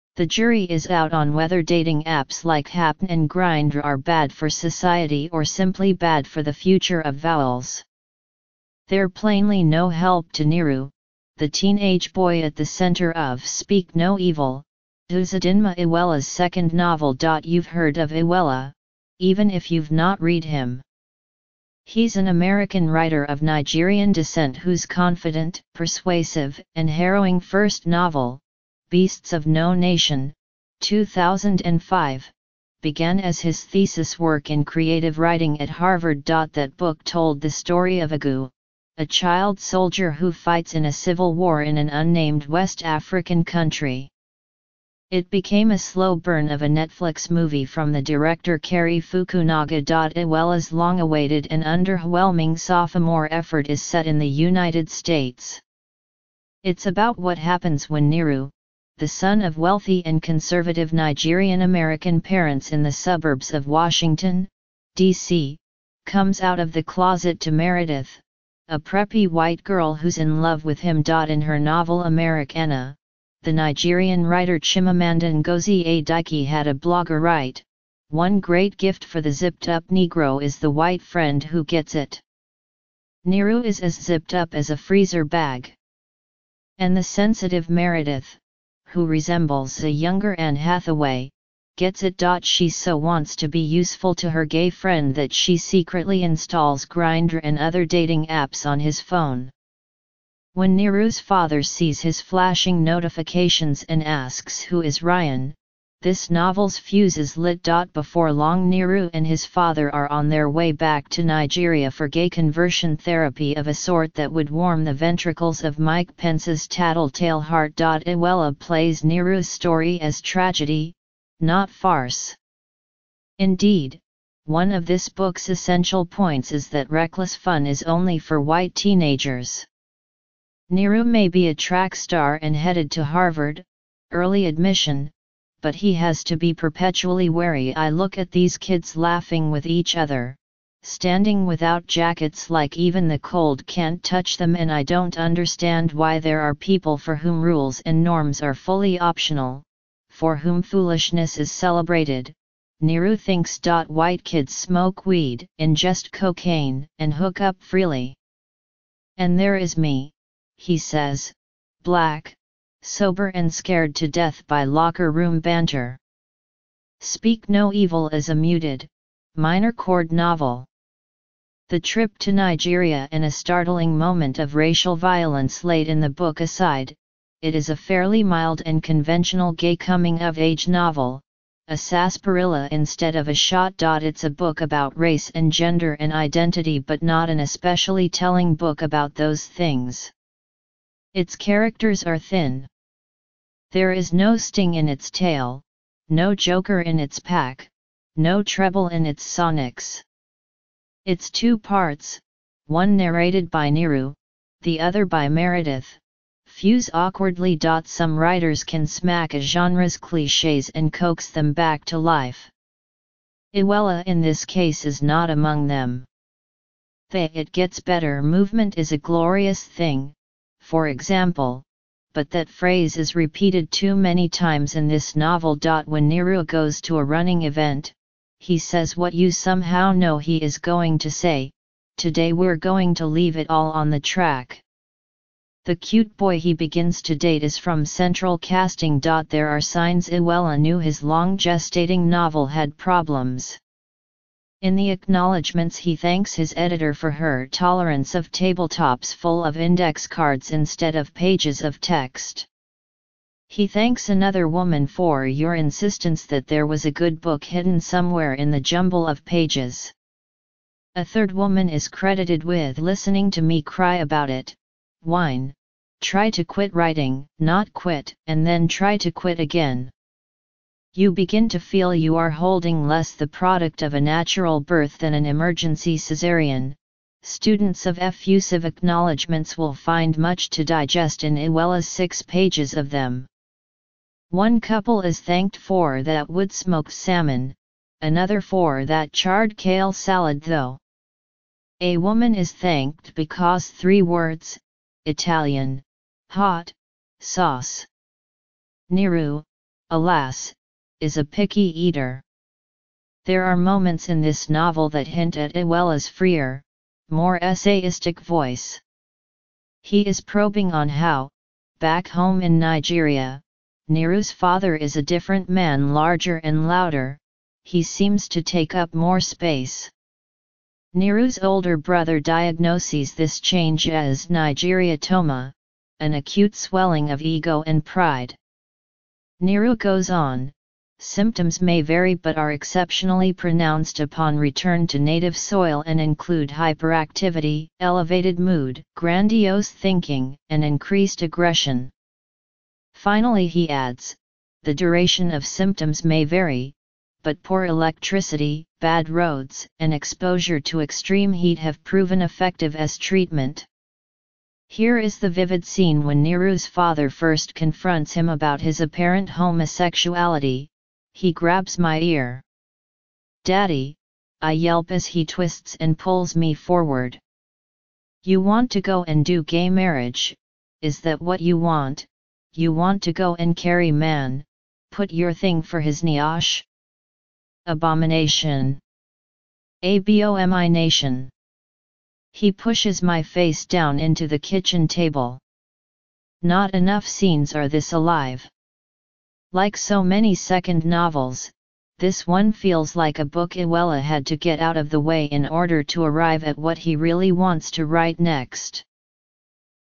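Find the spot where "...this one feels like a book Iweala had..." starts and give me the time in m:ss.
6:31.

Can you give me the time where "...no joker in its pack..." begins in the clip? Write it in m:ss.
3:16.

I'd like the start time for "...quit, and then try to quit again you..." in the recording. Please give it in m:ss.
4:27.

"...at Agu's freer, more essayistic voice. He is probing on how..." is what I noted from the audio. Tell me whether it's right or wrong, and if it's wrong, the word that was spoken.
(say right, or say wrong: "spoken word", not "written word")
wrong: "Iweala", not "Agu".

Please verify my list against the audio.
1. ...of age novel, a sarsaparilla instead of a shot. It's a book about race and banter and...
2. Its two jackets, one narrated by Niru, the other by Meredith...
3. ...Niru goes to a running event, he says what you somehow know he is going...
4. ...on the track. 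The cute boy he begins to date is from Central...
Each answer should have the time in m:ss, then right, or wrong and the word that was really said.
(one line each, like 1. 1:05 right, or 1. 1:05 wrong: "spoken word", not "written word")
1. 3:00 wrong: "gender", not "banter"
2. 3:21 wrong: "parts", not "jackets"
3. 3:46 right
4. 3:53 right.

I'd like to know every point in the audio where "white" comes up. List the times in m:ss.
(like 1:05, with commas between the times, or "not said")
1:09, 1:20, 2:08, 2:33.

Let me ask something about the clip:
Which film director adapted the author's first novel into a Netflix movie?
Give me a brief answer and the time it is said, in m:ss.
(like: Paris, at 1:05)
Cary Fukunaga, at 0:48.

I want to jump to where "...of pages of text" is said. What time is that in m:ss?
4:10.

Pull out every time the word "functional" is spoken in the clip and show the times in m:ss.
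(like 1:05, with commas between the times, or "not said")
not said.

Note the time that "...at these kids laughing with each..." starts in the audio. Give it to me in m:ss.
2:18.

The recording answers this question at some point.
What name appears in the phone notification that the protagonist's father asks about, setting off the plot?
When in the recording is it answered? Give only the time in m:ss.
1:45.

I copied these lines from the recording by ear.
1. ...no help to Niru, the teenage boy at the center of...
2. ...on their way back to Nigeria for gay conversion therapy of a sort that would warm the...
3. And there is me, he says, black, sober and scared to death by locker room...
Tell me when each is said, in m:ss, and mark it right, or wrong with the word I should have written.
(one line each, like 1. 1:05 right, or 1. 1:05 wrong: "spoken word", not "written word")
1. 0:09 right
2. 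1:50 right
3. 2:39 right.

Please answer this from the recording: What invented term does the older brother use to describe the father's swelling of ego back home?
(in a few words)
Nigeriatoma.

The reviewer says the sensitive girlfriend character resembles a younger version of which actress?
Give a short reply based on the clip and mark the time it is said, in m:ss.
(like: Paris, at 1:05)
Anne Hathaway, at 1:30.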